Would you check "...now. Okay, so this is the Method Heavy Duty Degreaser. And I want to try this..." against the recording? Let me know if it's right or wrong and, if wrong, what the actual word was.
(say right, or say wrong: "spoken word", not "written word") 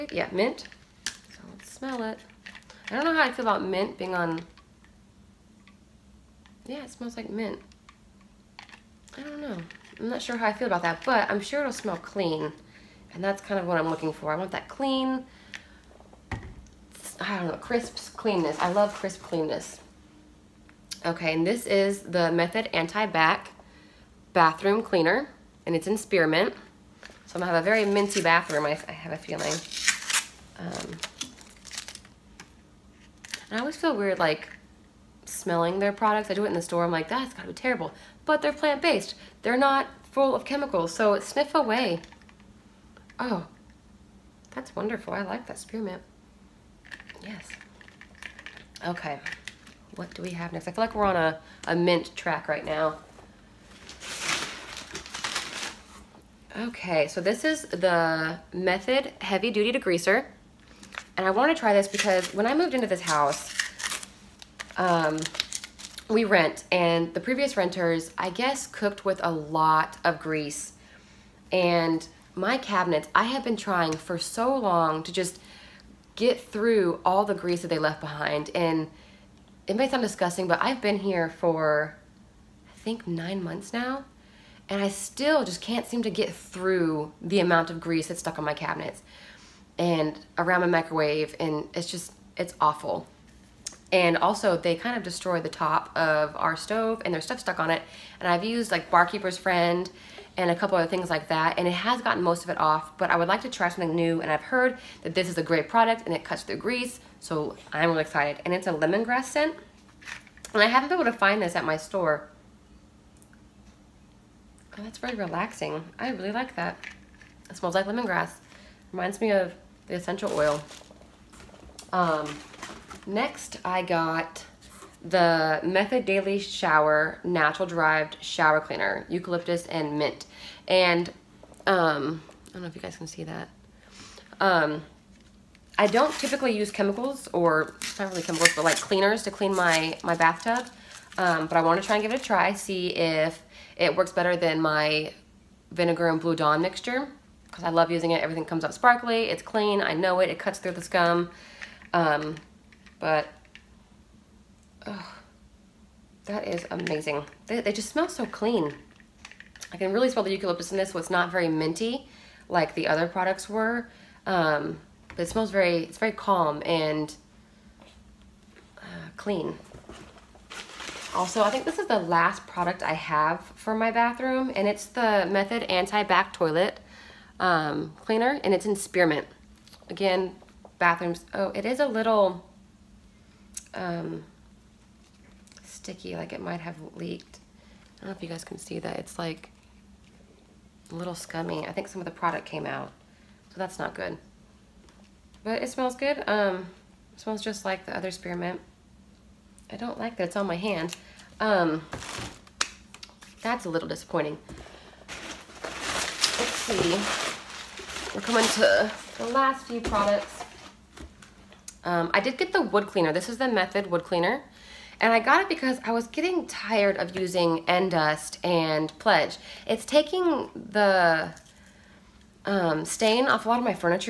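right.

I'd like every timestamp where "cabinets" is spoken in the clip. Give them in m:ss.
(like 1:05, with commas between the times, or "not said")
1:12, 1:28.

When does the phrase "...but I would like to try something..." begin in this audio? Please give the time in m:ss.
1:42.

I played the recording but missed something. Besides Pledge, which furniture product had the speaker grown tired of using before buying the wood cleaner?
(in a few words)
Endust.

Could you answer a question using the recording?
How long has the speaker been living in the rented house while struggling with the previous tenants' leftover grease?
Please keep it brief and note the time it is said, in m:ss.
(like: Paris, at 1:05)
9 months, at 1:23.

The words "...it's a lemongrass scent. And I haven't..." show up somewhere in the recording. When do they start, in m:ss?
1:48.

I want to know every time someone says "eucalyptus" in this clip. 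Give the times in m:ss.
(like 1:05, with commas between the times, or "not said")
2:09, 2:40.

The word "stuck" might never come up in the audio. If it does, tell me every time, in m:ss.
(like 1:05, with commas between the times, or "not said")
1:28, 1:37.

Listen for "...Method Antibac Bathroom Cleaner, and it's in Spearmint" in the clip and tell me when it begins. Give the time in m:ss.
0:22.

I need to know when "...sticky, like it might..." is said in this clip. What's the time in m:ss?
3:05.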